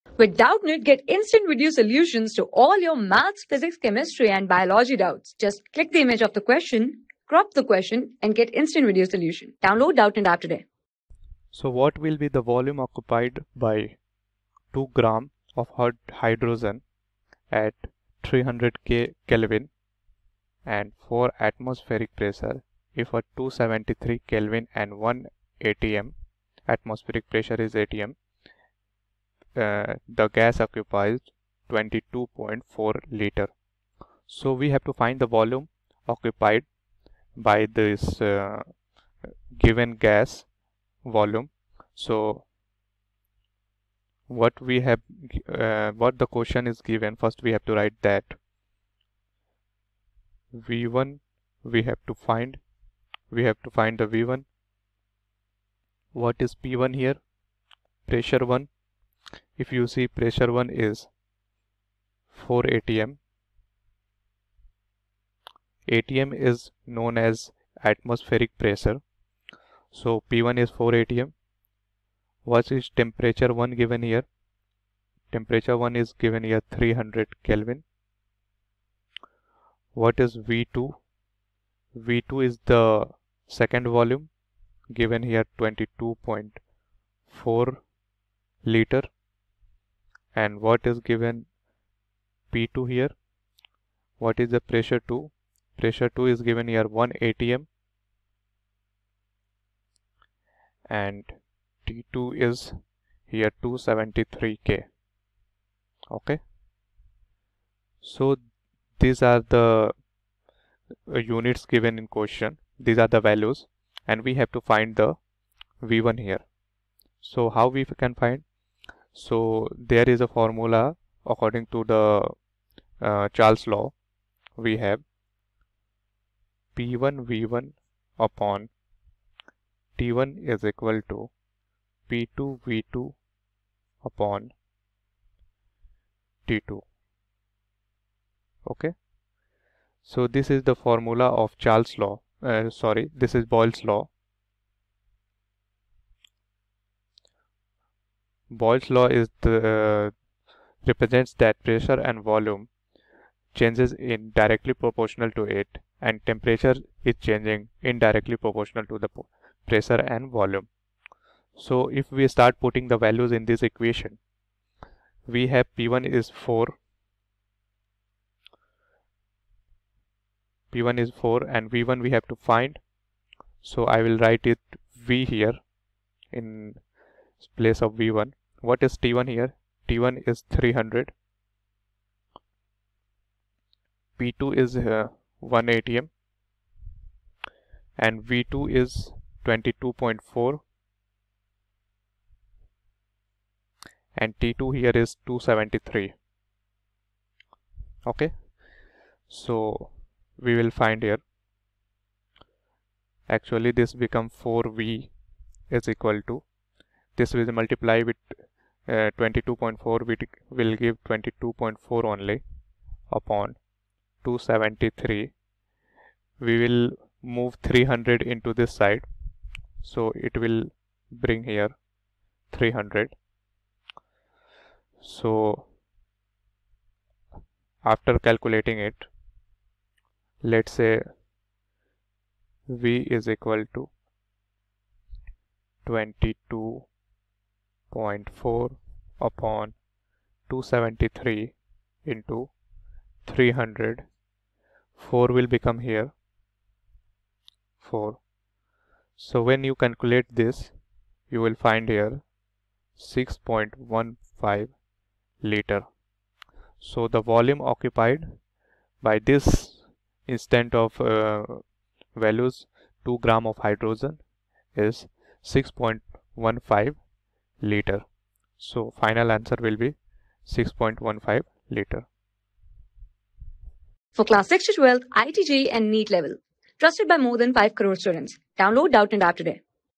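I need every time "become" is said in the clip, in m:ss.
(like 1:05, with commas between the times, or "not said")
3:23, 4:05.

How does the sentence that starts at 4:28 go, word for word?
So final answer will be 6.15 liter.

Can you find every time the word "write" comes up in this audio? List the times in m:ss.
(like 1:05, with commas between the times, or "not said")
0:47, 2:54.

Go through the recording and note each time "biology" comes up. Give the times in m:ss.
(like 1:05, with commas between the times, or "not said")
0:04.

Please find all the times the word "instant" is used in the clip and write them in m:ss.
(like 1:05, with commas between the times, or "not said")
0:01, 0:08, 4:20.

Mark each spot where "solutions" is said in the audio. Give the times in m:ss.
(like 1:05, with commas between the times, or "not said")
0:01, 0:09.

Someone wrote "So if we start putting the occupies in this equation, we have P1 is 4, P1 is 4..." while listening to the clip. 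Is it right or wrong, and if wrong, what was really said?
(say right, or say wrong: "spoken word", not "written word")
wrong: "values", not "occupies".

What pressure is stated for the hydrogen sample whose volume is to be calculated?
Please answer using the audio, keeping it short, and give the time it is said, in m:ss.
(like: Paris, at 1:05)
4 atm, at 0:21.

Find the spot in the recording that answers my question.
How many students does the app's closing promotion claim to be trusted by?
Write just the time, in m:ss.
4:37.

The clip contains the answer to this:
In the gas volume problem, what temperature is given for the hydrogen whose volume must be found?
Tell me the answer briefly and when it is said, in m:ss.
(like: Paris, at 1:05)
300 Kelvin, at 0:18.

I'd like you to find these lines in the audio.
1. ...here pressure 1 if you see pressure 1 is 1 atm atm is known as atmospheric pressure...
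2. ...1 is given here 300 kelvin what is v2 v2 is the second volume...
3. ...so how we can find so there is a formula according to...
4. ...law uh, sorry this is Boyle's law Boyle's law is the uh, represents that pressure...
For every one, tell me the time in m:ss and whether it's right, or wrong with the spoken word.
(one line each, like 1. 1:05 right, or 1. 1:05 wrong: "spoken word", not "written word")
1. 0:56 wrong: "4", not "1"
2. 1:15 right
3. 1:57 right
4. 2:21 right.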